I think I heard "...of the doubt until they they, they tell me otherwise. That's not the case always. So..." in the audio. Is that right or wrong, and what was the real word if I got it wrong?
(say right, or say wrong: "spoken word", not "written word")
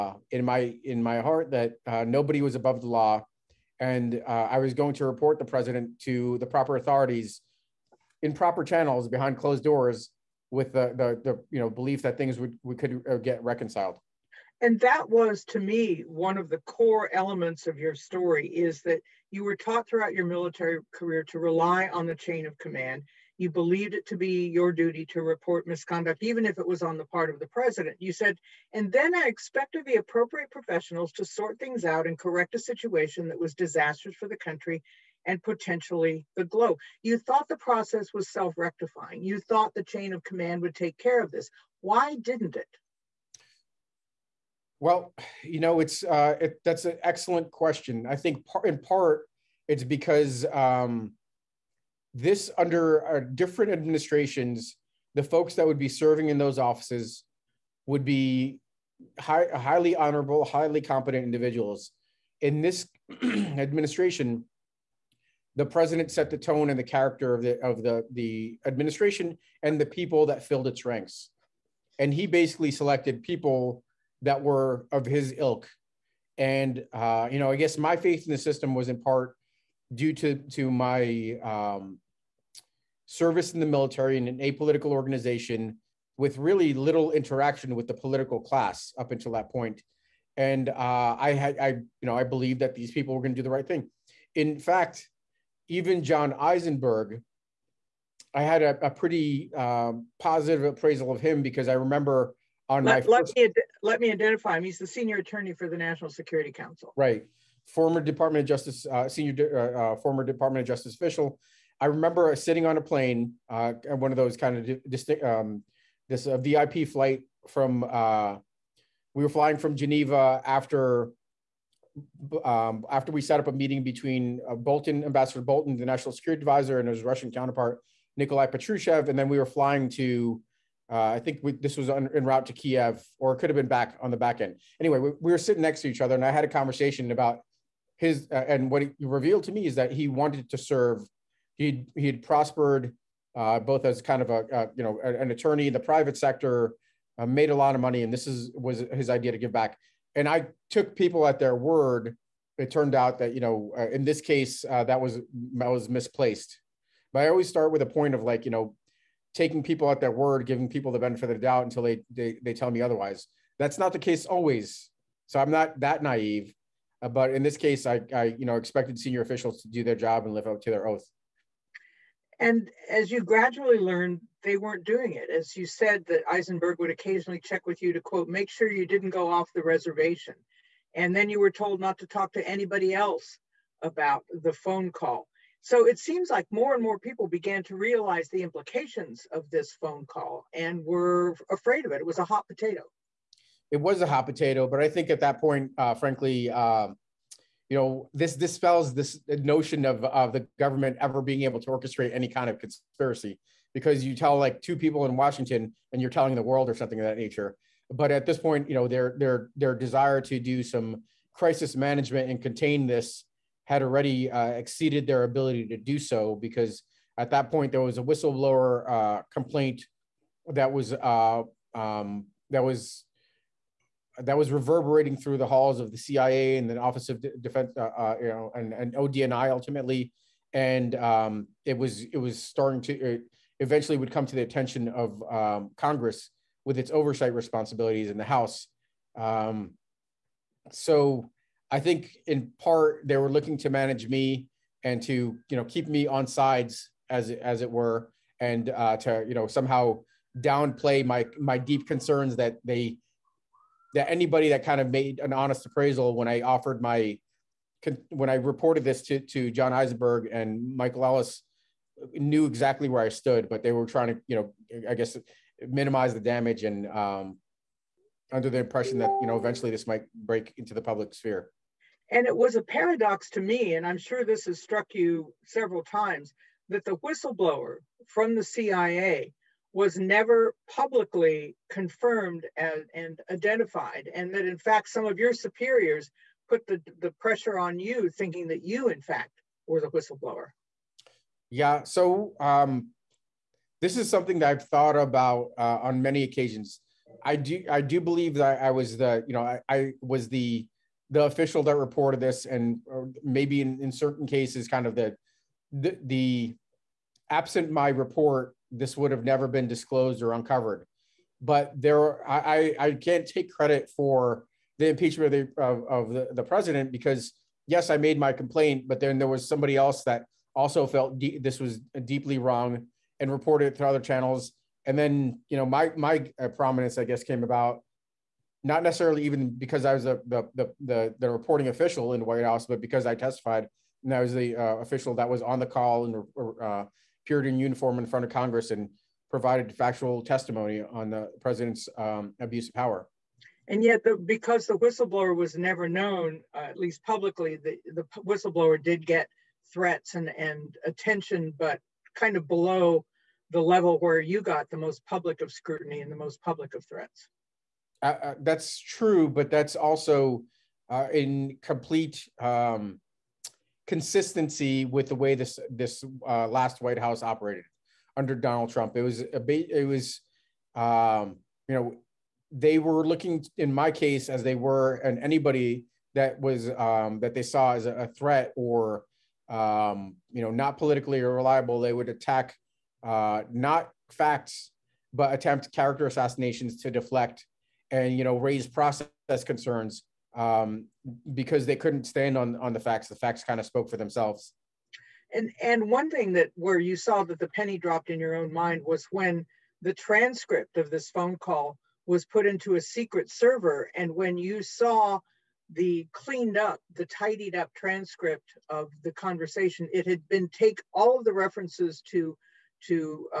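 right.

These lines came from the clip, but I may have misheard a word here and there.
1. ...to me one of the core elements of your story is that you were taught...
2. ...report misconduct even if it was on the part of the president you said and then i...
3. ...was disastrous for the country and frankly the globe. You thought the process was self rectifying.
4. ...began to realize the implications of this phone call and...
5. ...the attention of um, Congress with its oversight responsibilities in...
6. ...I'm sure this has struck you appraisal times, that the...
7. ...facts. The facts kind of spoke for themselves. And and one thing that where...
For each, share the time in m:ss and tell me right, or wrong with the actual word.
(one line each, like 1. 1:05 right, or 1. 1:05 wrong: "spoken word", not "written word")
1. 0:15 right
2. 0:25 right
3. 0:33 wrong: "potentially", not "frankly"
4. 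3:07 right
5. 3:54 right
6. 4:33 wrong: "several", not "appraisal"
7. 6:32 right.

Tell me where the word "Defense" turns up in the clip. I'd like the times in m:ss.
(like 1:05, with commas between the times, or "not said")
3:47.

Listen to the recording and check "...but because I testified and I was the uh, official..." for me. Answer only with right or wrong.
right.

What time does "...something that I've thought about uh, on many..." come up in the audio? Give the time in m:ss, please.
4:54.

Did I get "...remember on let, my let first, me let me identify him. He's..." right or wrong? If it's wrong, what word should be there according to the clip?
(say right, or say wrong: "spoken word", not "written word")
right.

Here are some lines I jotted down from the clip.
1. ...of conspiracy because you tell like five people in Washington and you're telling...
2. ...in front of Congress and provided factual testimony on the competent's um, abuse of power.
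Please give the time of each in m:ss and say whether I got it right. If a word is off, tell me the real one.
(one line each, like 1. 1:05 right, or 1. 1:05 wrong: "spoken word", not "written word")
1. 3:22 wrong: "two", not "five"
2. 5:37 wrong: "president", not "competent".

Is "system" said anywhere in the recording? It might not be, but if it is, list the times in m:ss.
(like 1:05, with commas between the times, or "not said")
1:18.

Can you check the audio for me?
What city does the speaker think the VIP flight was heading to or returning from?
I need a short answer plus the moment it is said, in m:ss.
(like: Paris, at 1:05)
Kiev, at 2:12.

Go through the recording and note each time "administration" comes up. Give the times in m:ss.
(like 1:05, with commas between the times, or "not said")
0:53, 1:03, 1:08.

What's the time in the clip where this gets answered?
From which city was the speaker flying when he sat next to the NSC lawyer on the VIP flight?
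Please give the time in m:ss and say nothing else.
1:59.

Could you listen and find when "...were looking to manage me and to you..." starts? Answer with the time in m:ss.
4:03.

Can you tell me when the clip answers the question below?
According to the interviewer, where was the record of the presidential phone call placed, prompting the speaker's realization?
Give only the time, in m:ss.
6:42.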